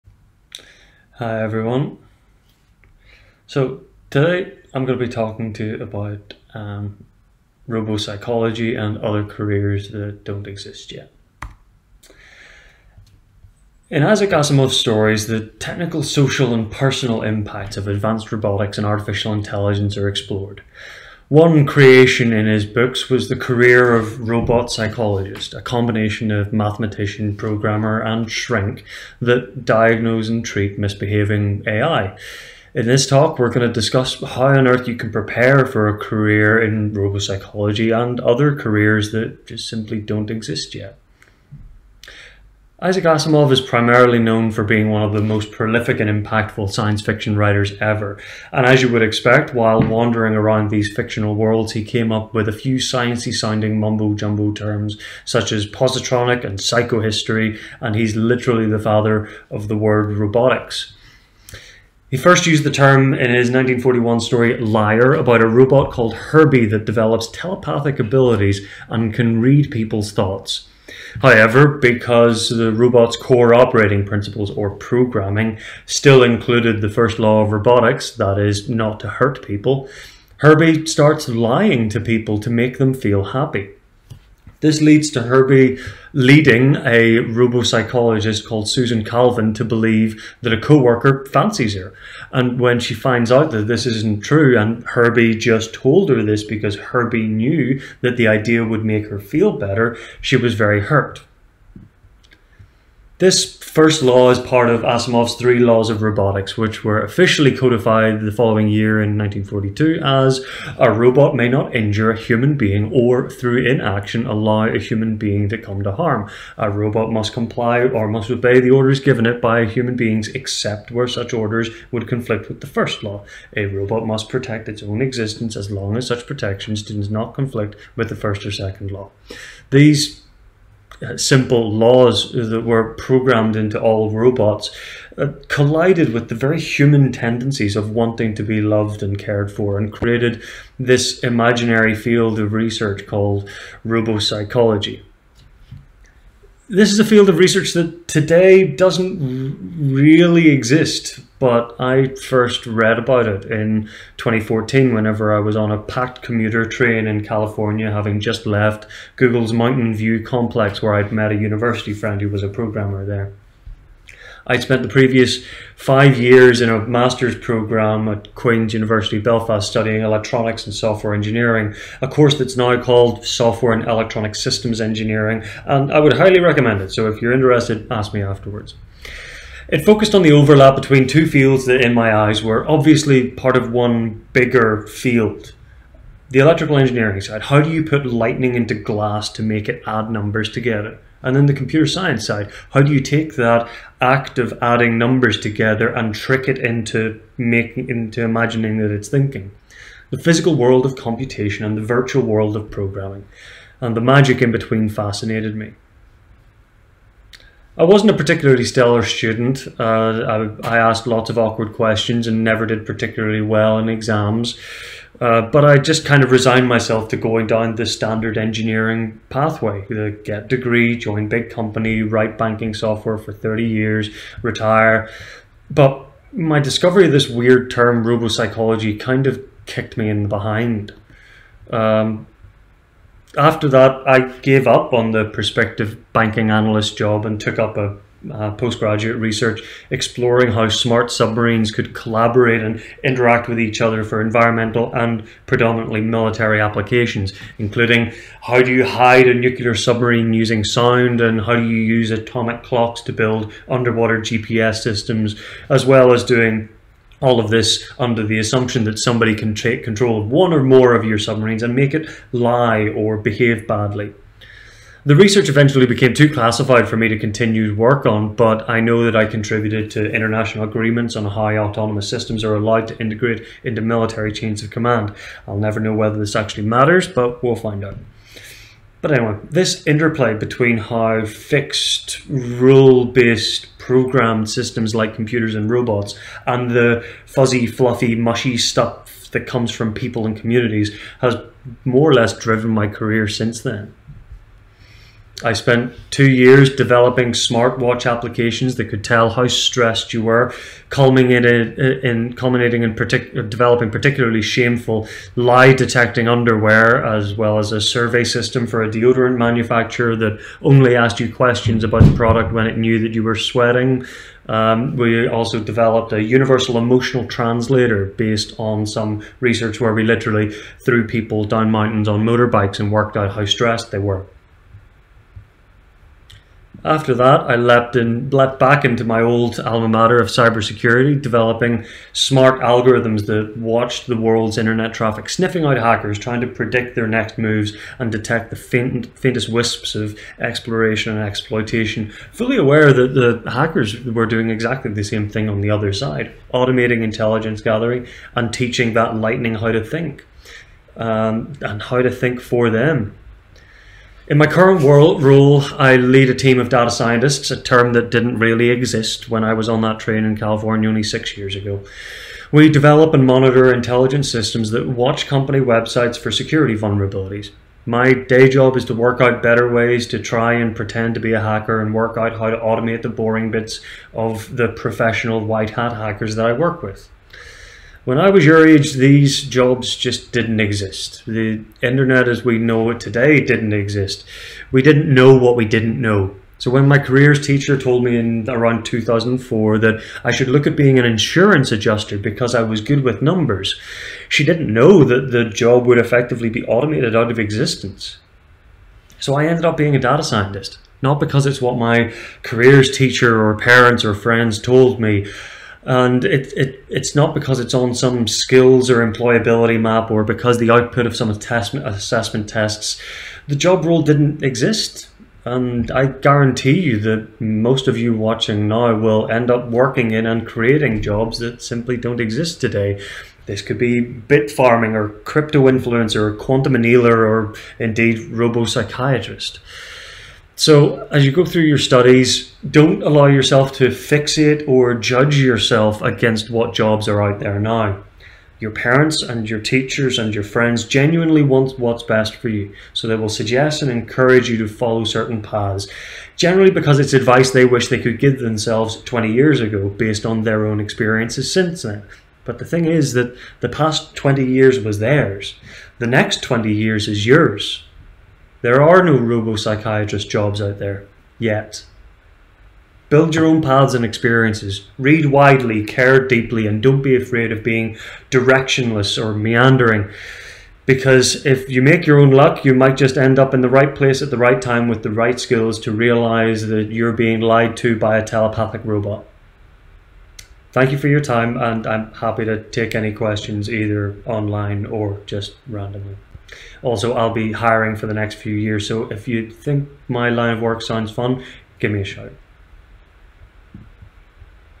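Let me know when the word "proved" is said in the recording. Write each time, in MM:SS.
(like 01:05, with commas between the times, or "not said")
not said.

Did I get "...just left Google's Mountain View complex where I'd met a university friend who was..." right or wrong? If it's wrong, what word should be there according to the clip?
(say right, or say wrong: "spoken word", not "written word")
right.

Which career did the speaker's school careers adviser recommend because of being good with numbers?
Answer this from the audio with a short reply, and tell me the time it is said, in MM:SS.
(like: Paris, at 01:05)
insurance adjuster, at 06:31.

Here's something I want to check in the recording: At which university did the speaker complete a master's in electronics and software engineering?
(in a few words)
Queen's University Belfast.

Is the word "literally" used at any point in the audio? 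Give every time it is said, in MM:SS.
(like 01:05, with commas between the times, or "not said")
00:58, 05:20.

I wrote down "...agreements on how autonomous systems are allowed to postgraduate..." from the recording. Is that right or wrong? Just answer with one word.
wrong.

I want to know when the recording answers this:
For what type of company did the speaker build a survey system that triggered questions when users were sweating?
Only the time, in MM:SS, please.
05:08.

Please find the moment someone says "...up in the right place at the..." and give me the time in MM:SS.
07:53.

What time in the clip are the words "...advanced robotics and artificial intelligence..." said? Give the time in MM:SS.
00:17.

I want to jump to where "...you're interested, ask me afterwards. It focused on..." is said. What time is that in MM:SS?
02:57.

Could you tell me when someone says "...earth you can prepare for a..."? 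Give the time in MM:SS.
00:34.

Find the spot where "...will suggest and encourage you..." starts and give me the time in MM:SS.
07:23.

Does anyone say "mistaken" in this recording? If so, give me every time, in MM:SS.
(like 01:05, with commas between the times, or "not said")
not said.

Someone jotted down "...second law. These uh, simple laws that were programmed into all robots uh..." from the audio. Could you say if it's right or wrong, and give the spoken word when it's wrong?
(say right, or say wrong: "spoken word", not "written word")
right.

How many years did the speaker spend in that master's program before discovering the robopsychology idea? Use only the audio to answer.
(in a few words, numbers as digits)
5.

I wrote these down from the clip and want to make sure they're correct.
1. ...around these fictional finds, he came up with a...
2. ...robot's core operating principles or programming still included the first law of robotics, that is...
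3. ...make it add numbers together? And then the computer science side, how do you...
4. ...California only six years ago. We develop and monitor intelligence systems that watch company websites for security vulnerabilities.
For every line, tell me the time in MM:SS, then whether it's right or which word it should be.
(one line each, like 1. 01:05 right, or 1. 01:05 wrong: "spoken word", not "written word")
1. 00:50 wrong: "worlds", not "finds"
2. 01:12 right
3. 03:09 right
4. 06:00 right.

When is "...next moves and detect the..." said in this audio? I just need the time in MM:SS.
05:37.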